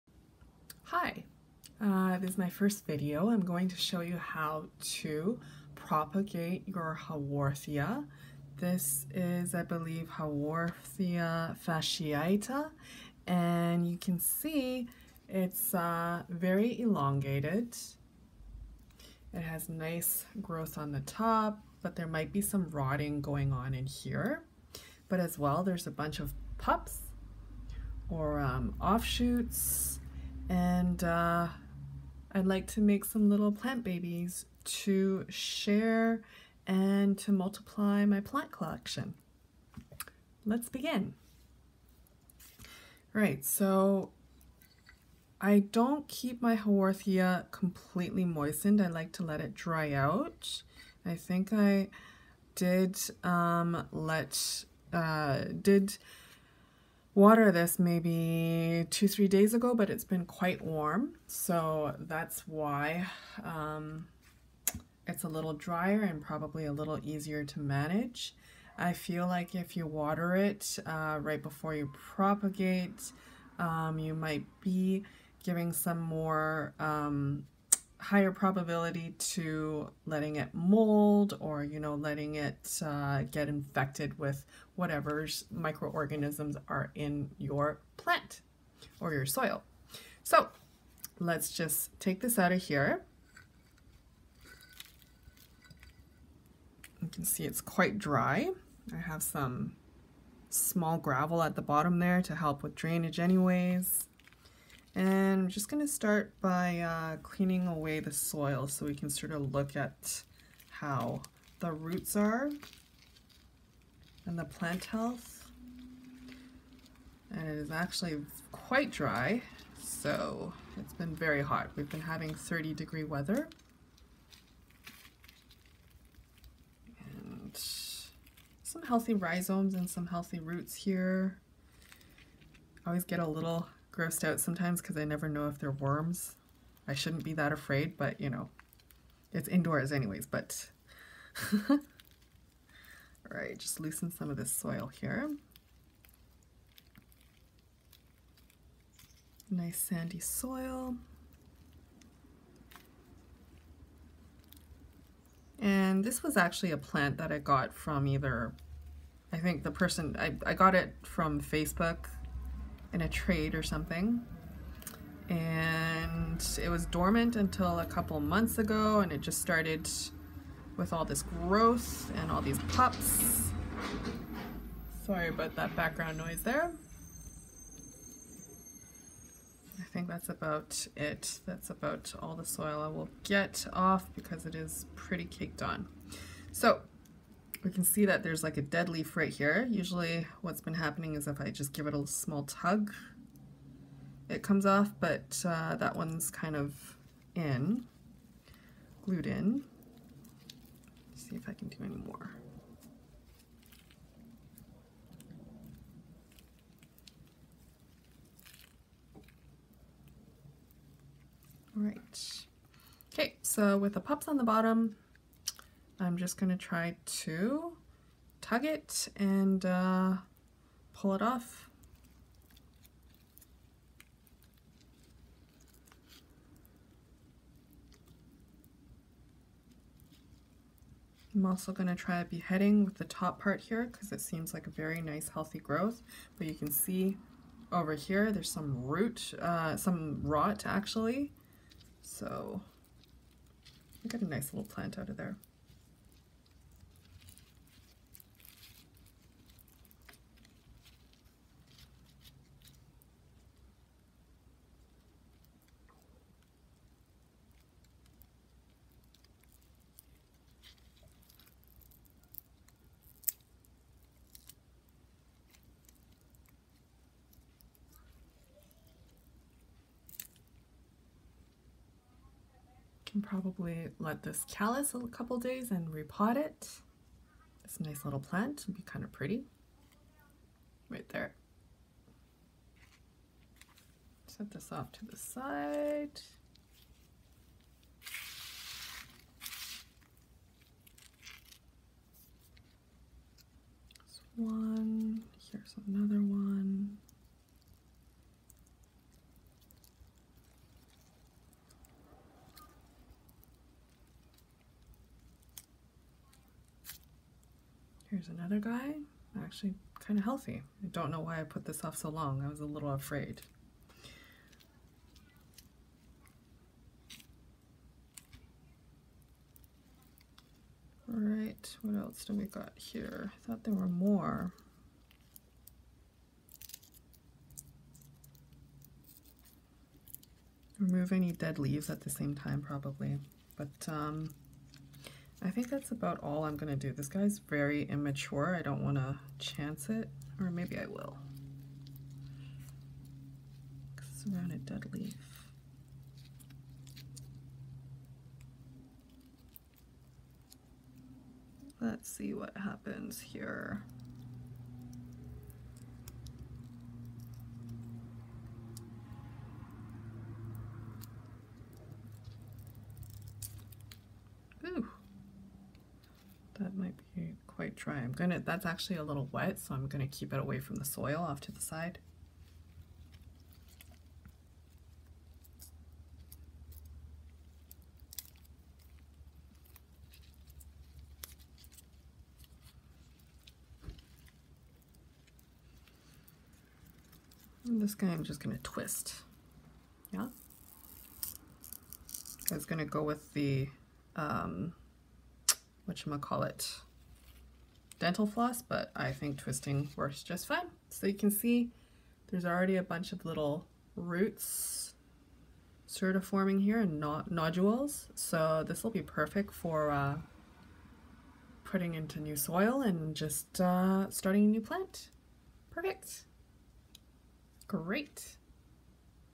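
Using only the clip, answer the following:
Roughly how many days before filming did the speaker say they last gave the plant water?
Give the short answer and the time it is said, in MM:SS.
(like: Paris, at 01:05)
2-3 days, at 00:58.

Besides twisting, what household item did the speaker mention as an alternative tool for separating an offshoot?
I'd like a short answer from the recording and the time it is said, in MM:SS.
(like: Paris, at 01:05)
Dental floss, at 06:38.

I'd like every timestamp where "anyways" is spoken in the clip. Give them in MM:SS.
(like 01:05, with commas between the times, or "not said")
01:43, 02:19.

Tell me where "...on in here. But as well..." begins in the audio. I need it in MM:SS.
00:23.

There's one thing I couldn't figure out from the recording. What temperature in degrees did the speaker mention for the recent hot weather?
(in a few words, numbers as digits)
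30.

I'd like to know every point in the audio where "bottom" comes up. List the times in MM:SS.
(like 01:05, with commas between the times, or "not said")
01:41, 03:34.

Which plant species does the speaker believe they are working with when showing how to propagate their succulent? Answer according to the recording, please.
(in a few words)
Haworthia fasciata.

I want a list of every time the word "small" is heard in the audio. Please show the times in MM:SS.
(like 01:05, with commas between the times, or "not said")
01:40, 03:12.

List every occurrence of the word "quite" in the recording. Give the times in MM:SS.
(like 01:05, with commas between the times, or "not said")
01:00, 01:37, 01:58.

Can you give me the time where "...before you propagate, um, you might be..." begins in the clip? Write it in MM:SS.
01:11.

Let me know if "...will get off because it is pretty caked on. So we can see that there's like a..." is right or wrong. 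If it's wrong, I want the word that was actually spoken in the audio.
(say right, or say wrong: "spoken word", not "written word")
right.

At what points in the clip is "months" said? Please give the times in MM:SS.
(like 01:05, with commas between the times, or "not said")
02:48.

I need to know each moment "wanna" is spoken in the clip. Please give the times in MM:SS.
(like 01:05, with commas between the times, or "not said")
05:38.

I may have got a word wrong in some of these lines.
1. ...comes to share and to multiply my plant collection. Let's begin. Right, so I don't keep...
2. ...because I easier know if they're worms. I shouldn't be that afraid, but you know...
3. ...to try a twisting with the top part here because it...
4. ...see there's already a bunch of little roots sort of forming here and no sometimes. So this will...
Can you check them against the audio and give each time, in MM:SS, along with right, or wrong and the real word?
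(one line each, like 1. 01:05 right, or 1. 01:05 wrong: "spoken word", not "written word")
1. 00:33 wrong: "babies", not "comes"
2. 02:14 wrong: "never", not "easier"
3. 03:51 wrong: "beheading", not "twisting"
4. 06:41 wrong: "nodules", not "sometimes".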